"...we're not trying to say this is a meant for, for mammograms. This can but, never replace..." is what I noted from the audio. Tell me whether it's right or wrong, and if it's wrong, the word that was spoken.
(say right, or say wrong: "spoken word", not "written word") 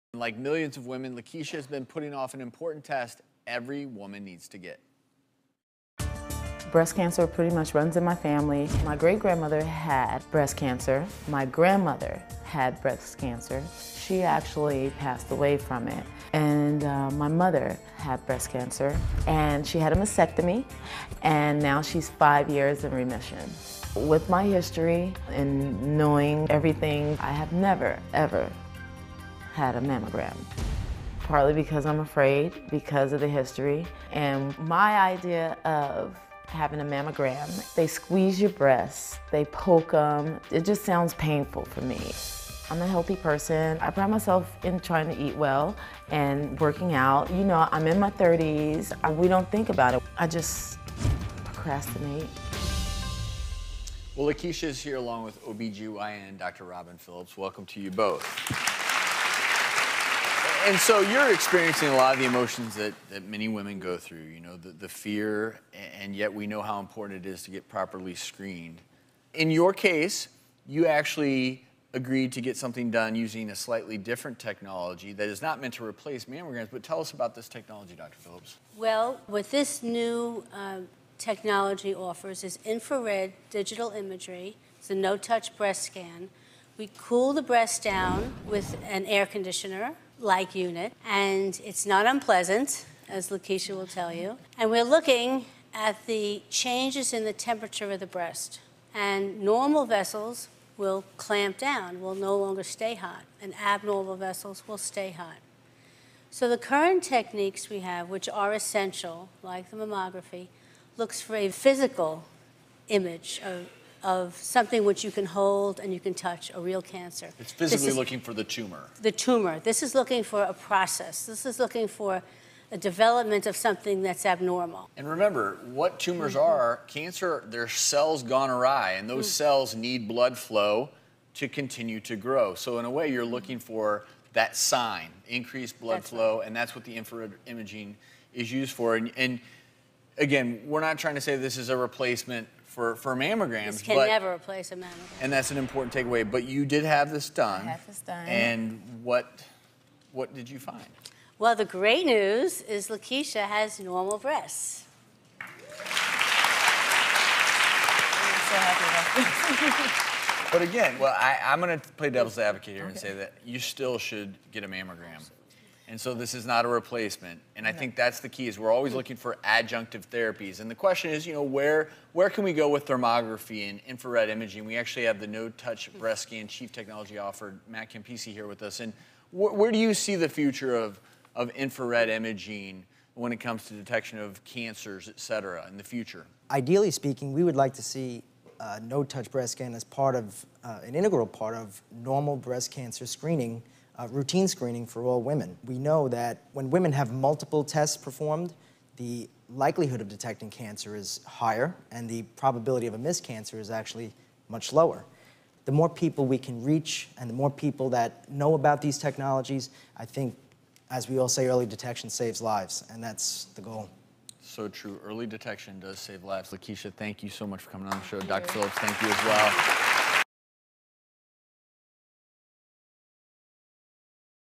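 wrong: "replacement", not "meant".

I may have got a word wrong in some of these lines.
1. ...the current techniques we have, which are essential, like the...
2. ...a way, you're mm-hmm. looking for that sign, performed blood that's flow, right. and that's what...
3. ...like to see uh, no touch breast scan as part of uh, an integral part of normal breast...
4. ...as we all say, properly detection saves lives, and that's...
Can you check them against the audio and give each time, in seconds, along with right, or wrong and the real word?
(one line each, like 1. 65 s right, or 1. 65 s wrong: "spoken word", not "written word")
1. 106 s right
2. 132 s wrong: "increased", not "performed"
3. 187 s right
4. 210 s wrong: "early", not "properly".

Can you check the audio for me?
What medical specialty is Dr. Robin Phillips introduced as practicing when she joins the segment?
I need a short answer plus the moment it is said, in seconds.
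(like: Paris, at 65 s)
OBGYN, at 55 s.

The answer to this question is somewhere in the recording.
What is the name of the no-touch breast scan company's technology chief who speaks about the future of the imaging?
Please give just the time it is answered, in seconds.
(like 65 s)
177 s.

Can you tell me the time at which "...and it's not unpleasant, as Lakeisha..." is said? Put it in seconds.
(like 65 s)
91 s.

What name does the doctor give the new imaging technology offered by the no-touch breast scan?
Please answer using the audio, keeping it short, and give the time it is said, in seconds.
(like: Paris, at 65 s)
Infrared digital imagery, at 82 s.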